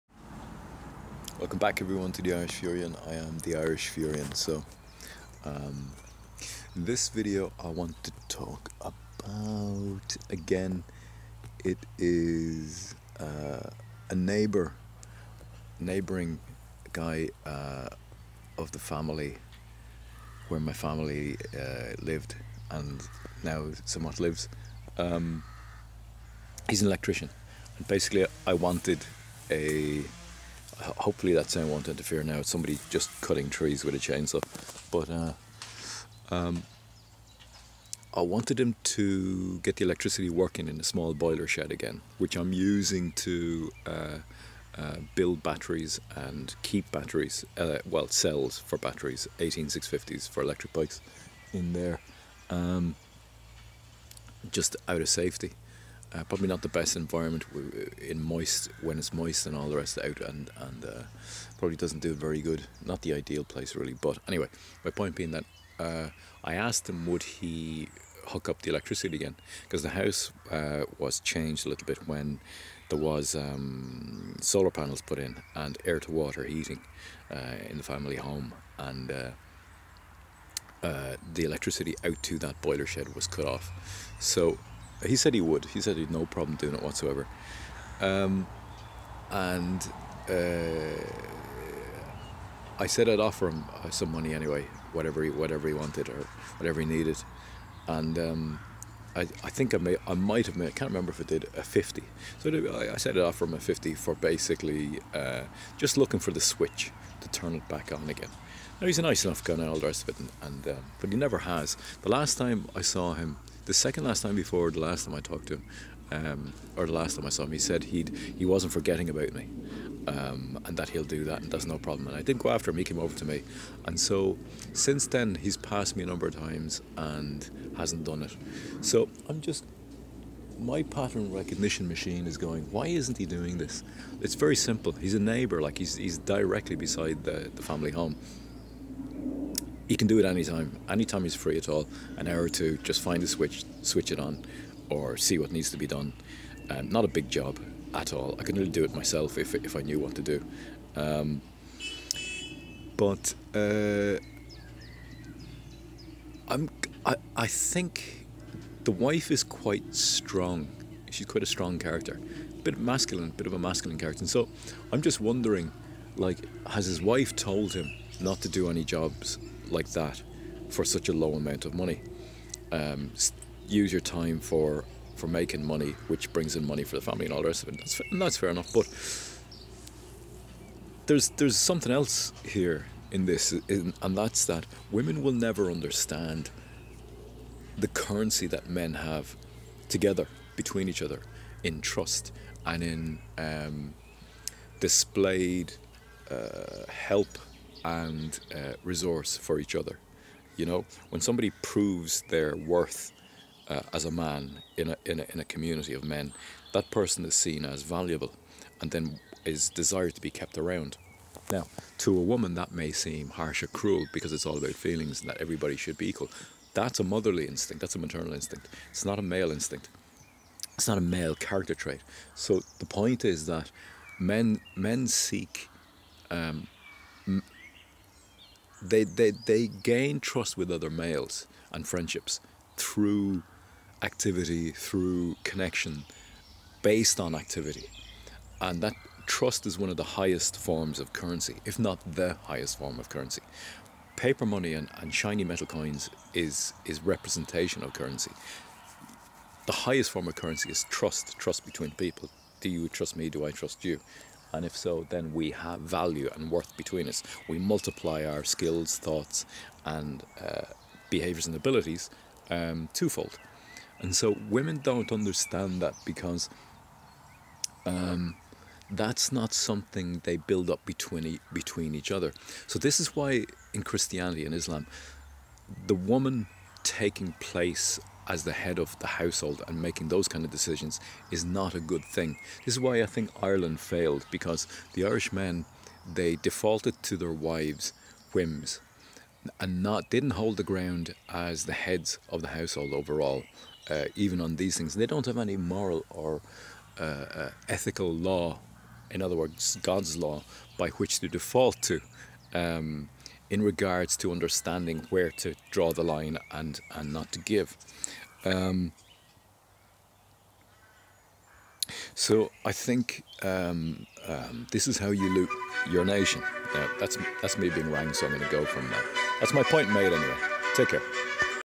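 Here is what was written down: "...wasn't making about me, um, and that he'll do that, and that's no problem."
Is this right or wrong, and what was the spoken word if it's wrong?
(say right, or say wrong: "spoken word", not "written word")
wrong: "forgetting", not "making".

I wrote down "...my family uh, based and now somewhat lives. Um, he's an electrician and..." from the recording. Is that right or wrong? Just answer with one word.
wrong.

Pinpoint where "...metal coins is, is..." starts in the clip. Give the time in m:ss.
4:05.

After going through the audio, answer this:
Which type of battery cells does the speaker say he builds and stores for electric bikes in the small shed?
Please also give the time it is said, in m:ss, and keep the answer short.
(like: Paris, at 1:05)
18650s, at 0:49.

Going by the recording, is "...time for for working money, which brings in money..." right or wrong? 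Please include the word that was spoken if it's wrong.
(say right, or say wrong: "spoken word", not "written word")
wrong: "making", not "working".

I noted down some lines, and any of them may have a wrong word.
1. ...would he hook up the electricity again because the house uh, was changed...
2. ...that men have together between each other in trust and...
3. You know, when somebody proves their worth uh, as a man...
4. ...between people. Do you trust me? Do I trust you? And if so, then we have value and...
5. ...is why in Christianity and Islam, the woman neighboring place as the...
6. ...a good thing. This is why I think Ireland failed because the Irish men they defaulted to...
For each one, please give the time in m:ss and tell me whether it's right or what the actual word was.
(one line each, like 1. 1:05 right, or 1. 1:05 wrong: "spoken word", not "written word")
1. 1:07 right
2. 3:08 right
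3. 3:20 right
4. 4:11 right
5. 4:32 wrong: "taking", not "neighboring"
6. 4:41 right.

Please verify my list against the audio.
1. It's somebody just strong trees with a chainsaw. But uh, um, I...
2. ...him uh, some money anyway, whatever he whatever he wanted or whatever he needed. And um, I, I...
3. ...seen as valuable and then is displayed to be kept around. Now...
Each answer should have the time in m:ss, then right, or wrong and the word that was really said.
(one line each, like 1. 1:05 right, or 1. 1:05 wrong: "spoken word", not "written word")
1. 0:32 wrong: "cutting", not "strong"
2. 1:33 right
3. 3:27 wrong: "desired", not "displayed".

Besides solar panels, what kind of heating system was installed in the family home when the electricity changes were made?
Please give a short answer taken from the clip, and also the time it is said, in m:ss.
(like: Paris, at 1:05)
air to water heating, at 1:15.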